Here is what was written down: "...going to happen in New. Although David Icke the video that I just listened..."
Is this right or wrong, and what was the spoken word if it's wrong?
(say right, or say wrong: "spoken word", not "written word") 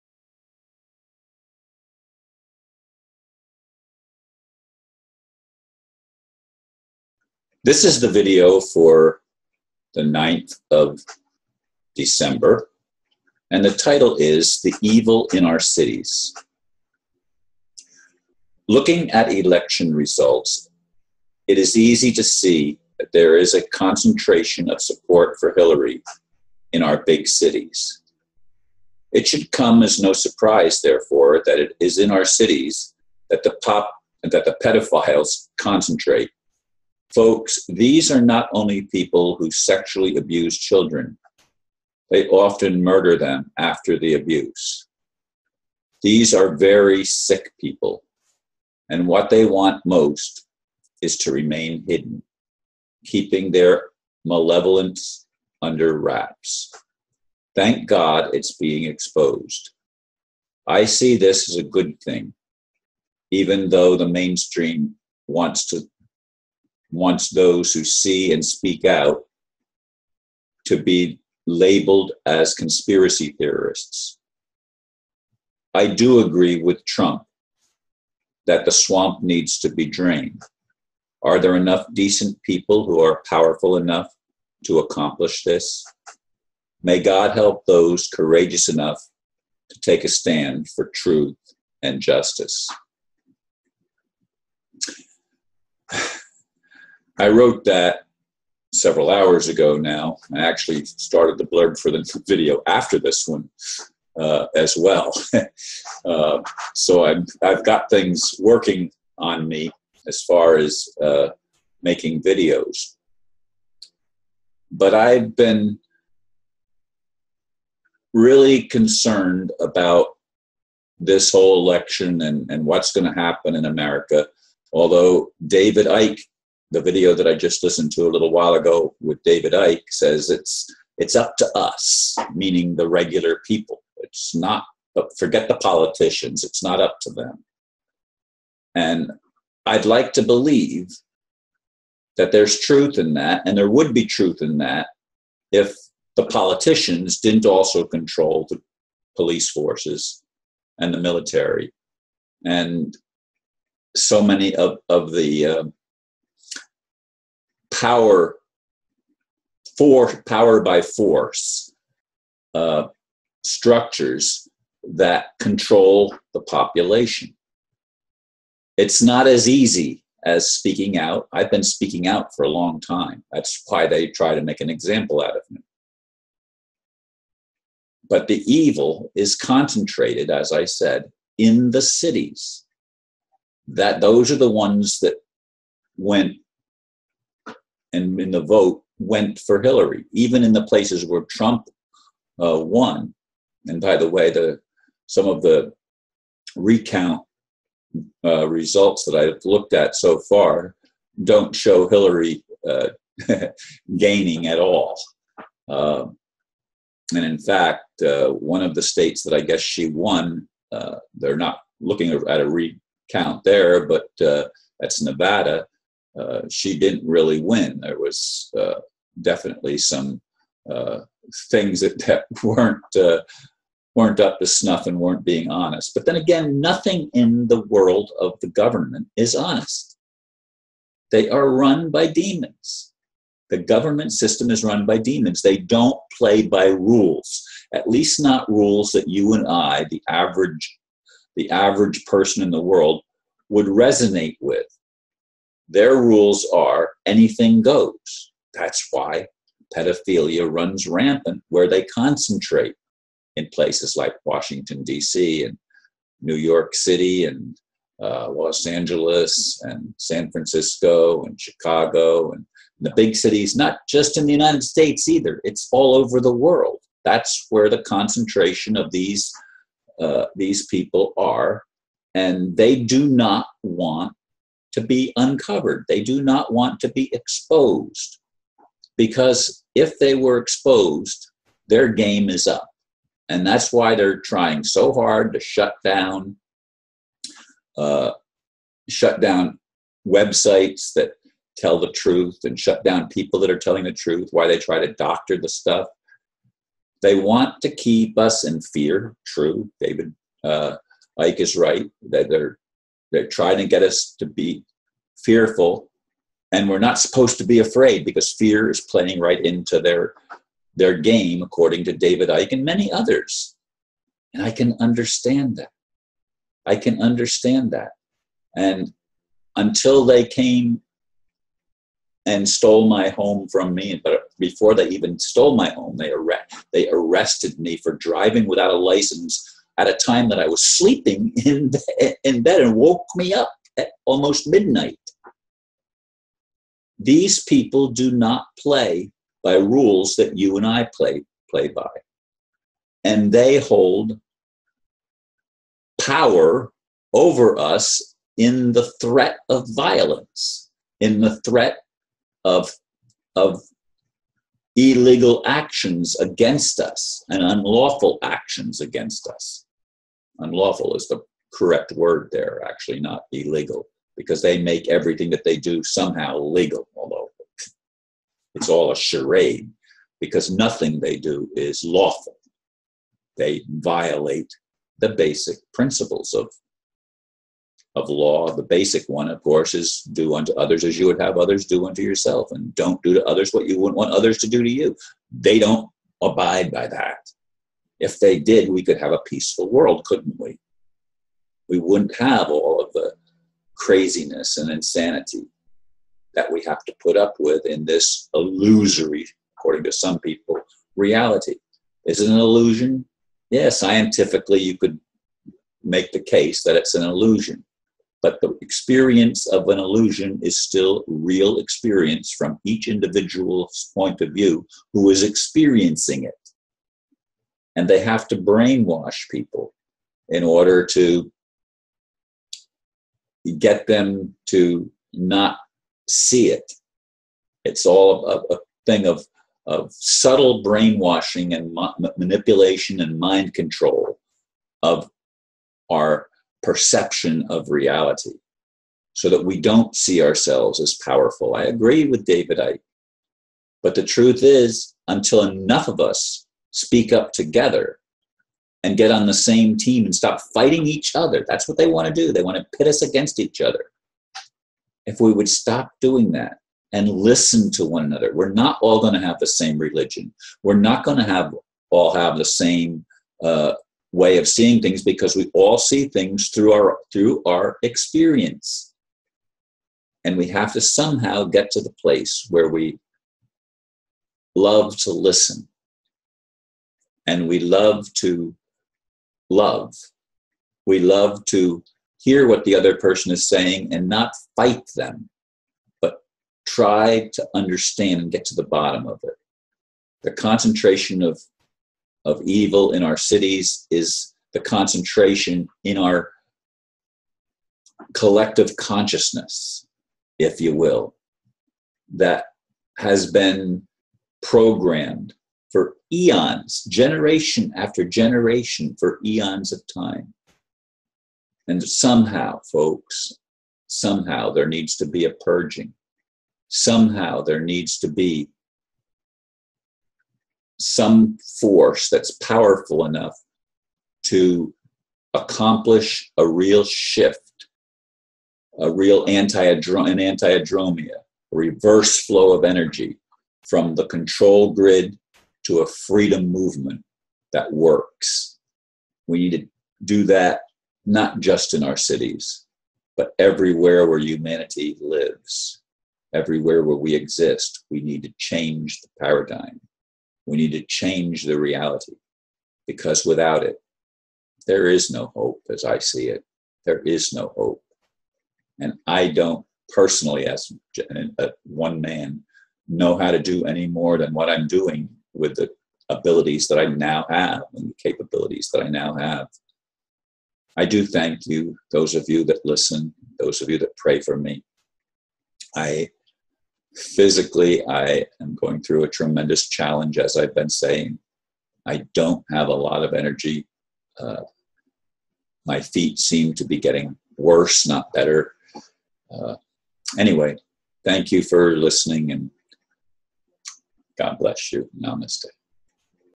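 wrong: "America", not "New".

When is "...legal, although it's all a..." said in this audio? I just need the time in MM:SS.
06:06.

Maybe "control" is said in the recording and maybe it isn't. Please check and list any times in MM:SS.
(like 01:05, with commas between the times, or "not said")
02:27, 02:45, 07:13, 08:54.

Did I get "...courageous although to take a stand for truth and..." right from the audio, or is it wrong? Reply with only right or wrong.
wrong.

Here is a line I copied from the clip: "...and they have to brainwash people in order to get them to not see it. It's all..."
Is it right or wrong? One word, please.
right.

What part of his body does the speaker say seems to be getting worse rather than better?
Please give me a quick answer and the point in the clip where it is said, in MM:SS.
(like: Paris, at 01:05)
feet, at 09:45.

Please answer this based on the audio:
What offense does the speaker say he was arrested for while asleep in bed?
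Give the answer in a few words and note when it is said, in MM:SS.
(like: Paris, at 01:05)
driving without a license, at 05:27.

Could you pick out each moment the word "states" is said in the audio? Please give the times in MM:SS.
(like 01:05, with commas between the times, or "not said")
03:28, 04:24.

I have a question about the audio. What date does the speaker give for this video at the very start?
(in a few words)
9th of December.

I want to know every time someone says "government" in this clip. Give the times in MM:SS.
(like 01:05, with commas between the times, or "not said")
03:48, 03:53.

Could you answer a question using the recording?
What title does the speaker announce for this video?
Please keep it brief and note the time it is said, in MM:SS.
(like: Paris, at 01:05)
The Evil in Our Cities, at 00:14.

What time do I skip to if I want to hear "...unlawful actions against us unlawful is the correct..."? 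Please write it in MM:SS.
05:57.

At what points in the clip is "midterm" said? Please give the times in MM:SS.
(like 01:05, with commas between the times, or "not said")
not said.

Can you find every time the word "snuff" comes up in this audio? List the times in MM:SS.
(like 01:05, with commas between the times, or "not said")
03:44.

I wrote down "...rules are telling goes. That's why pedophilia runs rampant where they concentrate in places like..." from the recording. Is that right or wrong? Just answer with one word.
wrong.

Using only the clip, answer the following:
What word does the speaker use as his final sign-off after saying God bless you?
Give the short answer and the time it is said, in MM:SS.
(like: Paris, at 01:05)
Namaste, at 09:54.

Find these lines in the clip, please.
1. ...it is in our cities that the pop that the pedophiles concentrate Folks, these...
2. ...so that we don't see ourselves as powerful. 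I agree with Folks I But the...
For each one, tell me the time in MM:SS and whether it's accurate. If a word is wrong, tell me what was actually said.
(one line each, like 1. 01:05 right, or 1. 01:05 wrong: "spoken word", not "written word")
1. 00:31 right
2. 07:19 wrong: "David", not "Folks".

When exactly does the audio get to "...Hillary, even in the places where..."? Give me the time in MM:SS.
03:09.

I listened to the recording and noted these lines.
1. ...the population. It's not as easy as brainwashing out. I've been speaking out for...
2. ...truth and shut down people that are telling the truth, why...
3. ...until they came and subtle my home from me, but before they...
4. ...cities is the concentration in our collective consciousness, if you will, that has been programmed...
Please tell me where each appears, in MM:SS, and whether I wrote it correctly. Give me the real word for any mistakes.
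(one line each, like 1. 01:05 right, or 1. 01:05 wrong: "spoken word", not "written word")
1. 02:46 wrong: "speaking", not "brainwashing"
2. 04:51 right
3. 05:19 wrong: "stole", not "subtle"
4. 08:13 right.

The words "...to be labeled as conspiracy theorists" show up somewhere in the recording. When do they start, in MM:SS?
01:10.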